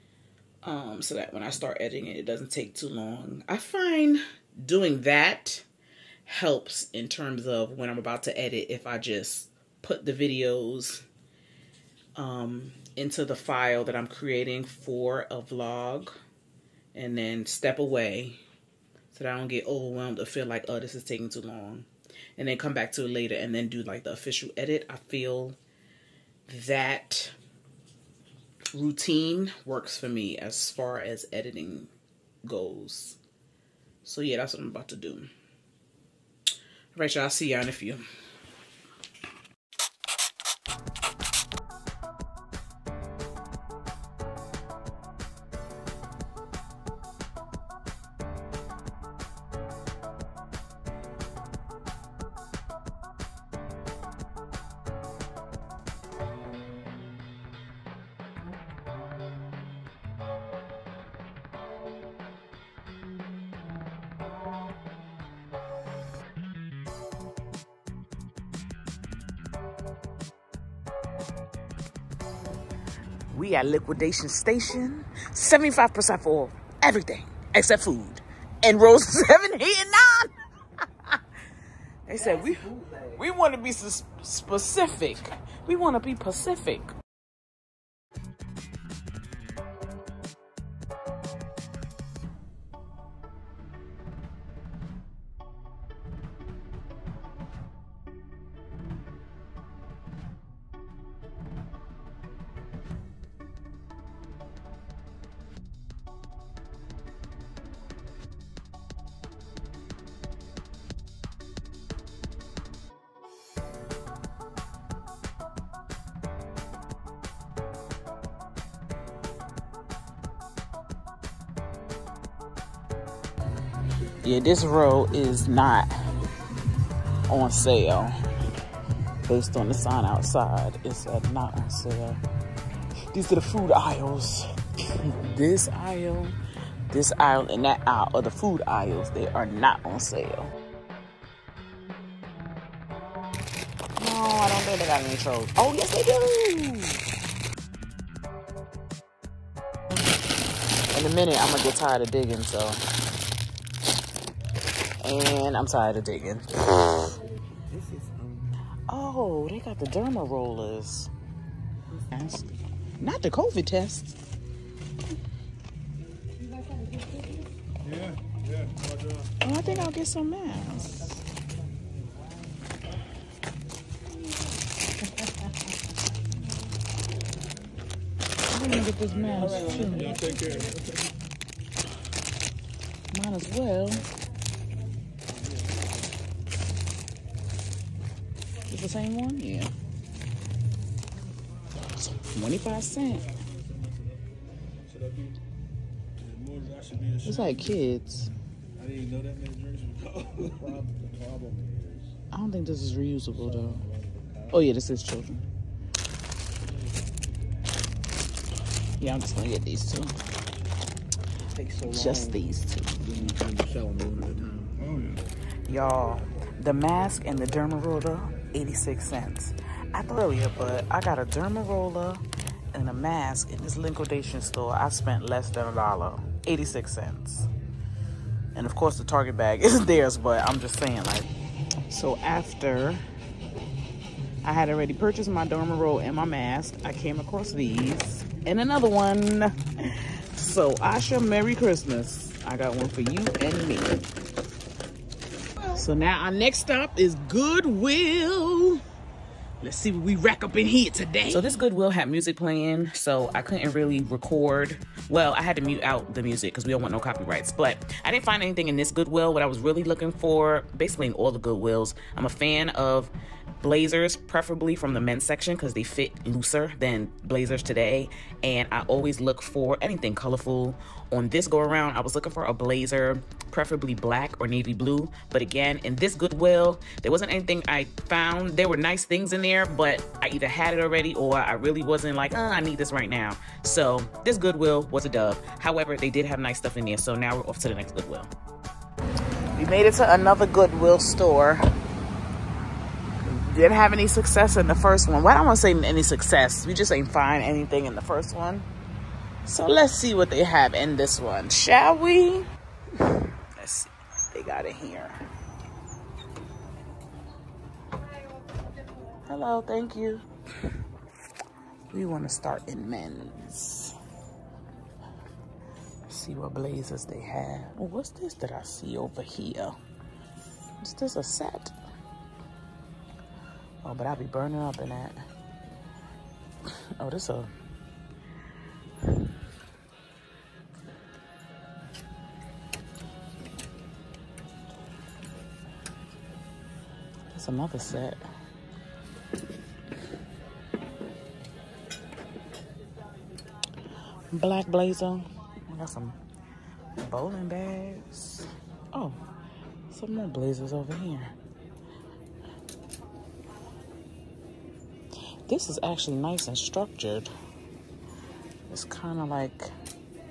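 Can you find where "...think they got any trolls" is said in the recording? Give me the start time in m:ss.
2:24.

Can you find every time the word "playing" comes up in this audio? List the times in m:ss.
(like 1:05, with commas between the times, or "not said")
4:12.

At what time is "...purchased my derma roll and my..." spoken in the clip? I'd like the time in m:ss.
3:54.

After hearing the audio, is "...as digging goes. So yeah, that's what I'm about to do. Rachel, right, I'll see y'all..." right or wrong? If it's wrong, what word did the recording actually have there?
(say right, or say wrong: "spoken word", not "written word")
wrong: "editing", not "digging".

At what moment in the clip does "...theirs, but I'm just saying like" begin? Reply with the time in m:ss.
3:49.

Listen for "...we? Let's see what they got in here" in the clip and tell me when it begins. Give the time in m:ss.
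5:01.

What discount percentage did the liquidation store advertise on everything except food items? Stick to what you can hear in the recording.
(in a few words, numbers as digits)
75%.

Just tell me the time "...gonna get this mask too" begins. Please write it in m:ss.
2:58.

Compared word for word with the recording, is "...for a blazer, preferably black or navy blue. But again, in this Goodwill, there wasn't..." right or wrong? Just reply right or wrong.
right.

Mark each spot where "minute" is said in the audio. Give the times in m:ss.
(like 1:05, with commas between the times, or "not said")
2:31.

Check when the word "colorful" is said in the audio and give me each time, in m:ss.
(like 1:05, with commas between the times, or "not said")
4:30.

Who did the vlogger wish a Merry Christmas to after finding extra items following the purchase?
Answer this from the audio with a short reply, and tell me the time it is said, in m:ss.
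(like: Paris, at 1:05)
Asha, at 4:00.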